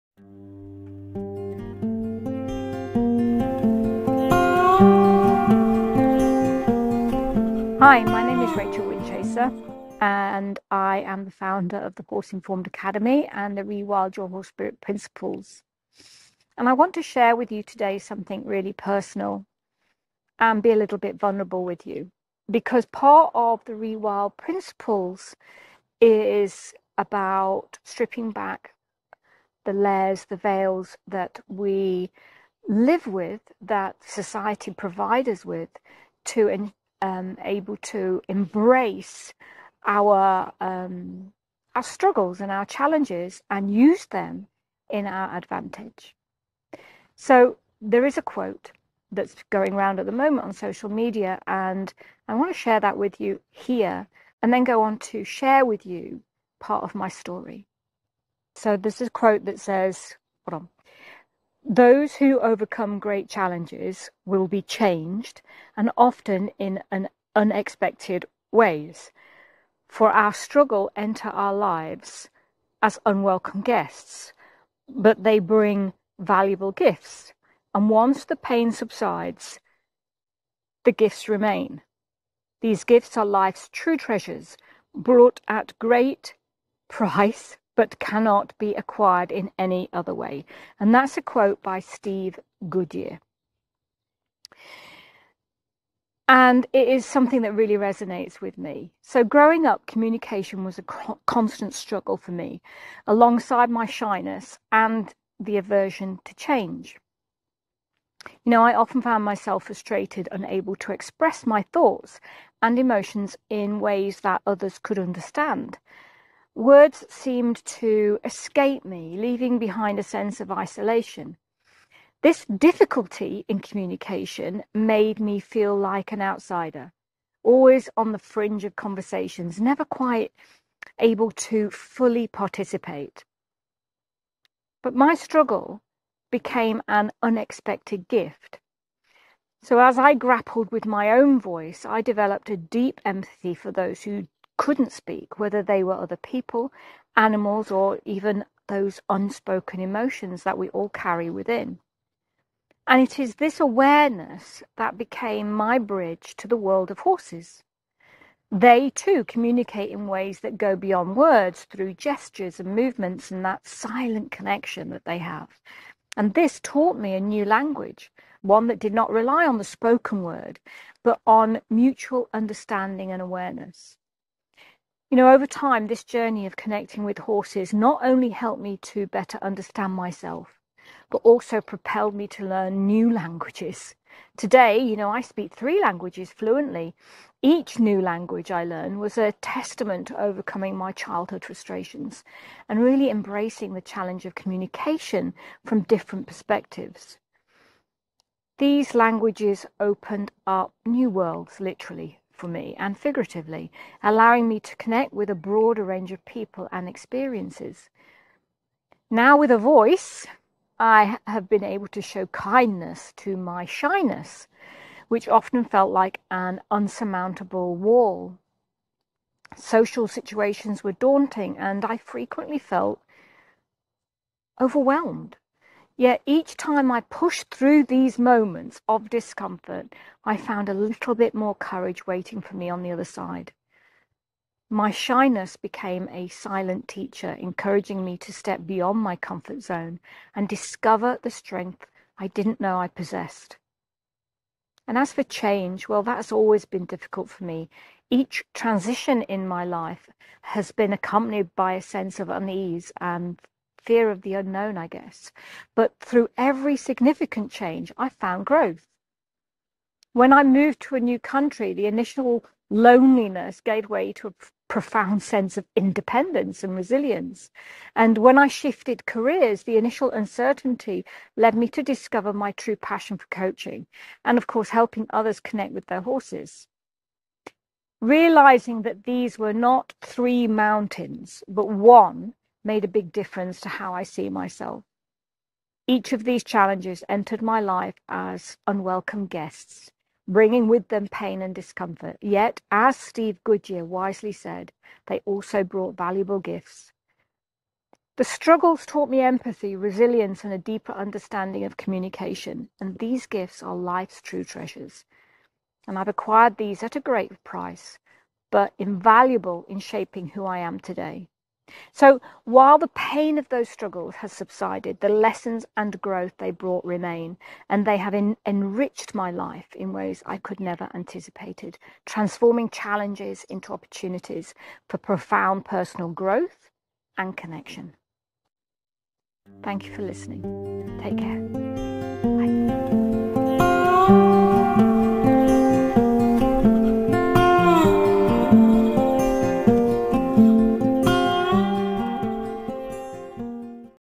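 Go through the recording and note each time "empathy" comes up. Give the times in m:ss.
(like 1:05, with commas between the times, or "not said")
2:23, 4:59.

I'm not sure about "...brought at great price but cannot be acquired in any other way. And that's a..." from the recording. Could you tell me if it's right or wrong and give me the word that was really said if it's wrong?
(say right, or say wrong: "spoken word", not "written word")
right.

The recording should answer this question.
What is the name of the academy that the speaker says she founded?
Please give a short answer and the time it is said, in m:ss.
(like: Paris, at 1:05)
Horse Informed Academy, at 0:12.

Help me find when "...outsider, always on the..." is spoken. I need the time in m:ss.
2:06.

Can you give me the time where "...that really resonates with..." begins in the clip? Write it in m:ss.
1:37.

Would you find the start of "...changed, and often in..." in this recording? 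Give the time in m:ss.
1:04.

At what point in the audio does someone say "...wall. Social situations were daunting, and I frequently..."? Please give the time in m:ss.
3:37.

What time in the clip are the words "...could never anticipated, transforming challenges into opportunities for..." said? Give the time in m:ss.
5:20.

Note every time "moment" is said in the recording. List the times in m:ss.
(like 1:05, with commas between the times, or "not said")
0:50, 3:48.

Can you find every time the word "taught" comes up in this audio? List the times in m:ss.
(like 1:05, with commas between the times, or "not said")
2:46, 4:58.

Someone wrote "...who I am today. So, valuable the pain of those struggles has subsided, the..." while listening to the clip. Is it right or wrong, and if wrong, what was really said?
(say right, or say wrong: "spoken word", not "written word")
wrong: "while", not "valuable".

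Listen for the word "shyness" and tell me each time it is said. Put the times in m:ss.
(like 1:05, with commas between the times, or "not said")
1:43, 3:33, 3:54.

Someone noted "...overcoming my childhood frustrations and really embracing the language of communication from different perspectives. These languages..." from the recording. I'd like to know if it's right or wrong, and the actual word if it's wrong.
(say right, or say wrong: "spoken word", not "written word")
wrong: "challenge", not "language".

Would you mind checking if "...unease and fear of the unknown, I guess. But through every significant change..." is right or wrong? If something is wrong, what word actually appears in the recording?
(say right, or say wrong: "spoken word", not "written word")
right.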